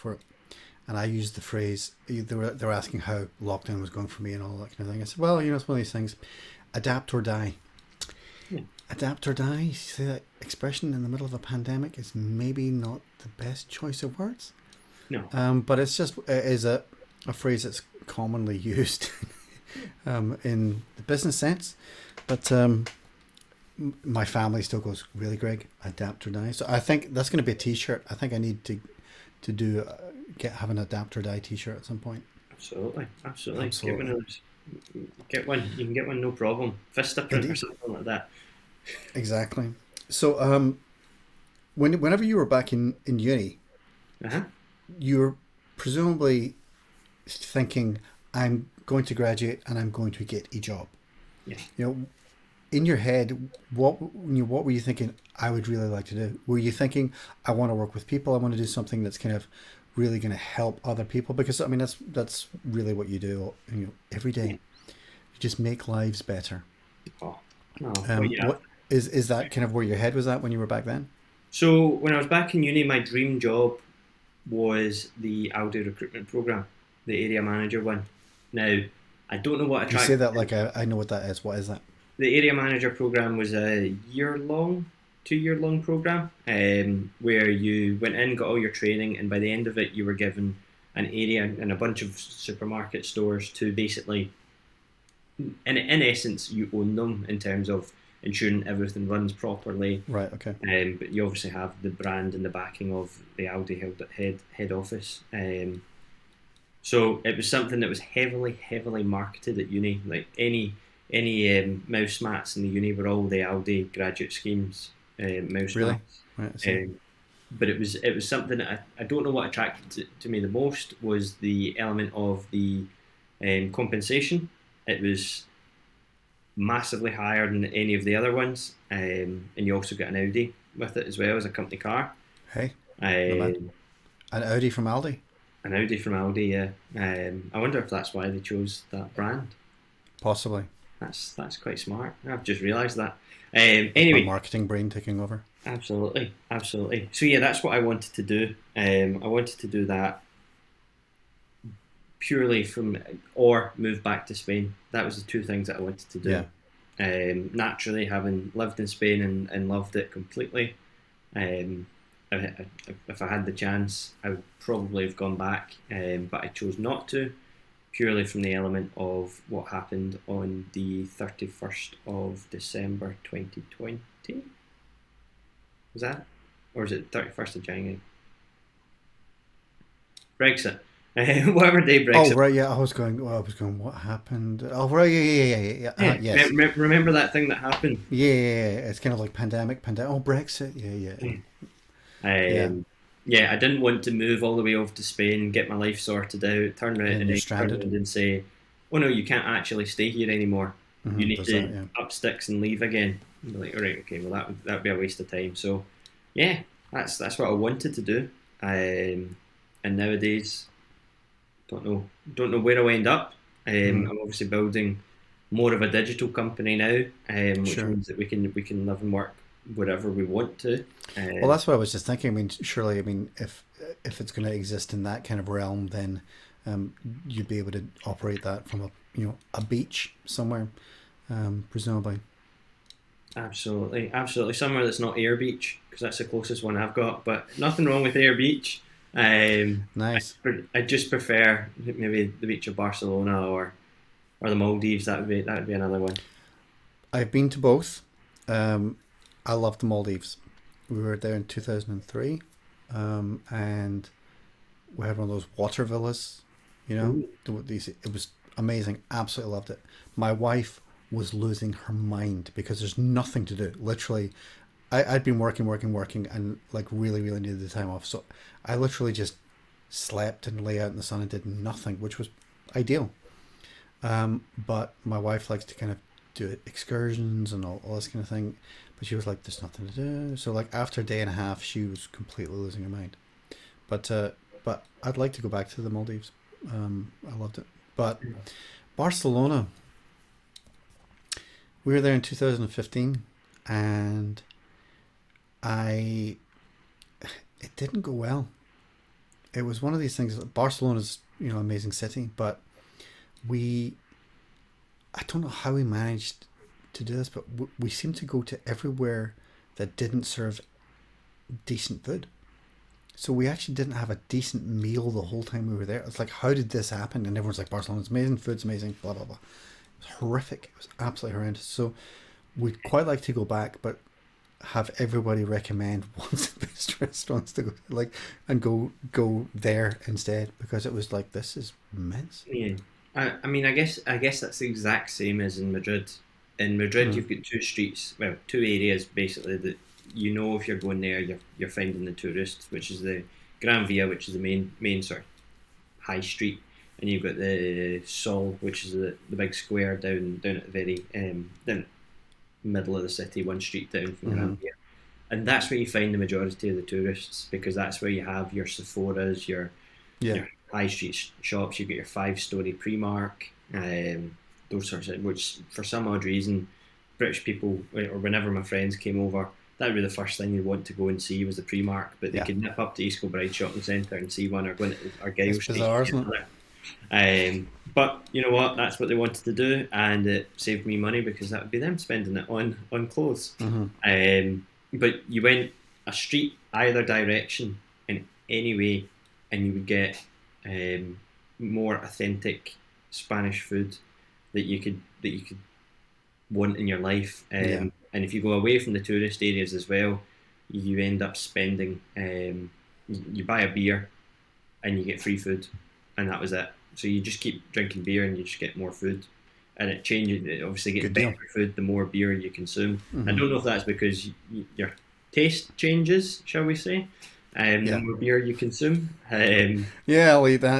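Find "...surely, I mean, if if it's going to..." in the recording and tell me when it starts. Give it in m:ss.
3:42.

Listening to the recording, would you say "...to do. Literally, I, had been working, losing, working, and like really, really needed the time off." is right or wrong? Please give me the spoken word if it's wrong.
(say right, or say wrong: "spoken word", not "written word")
wrong: "working", not "losing".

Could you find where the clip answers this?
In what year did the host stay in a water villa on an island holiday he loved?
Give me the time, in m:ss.
4:11.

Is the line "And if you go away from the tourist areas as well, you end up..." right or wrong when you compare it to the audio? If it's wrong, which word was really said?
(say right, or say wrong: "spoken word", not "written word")
right.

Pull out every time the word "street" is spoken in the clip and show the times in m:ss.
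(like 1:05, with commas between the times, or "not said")
5:37, 5:46, 5:53, 6:00, 6:26.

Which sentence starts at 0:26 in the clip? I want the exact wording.
So I think that's going to be a T-shirt.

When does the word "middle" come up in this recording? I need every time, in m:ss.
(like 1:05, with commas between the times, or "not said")
0:11, 5:52.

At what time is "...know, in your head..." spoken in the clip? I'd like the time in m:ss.
0:51.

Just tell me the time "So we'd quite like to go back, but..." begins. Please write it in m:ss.
5:21.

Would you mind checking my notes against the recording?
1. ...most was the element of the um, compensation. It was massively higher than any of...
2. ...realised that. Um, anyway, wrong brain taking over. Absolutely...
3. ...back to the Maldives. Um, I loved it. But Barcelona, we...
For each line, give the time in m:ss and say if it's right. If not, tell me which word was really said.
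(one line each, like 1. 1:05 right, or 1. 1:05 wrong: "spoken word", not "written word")
1. 2:00 right
2. 2:22 wrong: "marketing", not "wrong"
3. 4:45 right.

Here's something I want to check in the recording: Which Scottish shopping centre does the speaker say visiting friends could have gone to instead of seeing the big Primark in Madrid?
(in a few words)
East Kilbride Shopping Centre.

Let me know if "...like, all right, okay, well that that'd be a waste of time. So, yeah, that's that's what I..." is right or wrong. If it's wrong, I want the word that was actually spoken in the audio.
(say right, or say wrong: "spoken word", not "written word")
right.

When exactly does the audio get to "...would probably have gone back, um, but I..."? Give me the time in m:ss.
2:44.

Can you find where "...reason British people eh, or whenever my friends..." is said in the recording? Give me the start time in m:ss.
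6:06.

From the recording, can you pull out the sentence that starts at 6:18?
That's what they wanted to do, and it saved me money because that would be them spending it on on clothes.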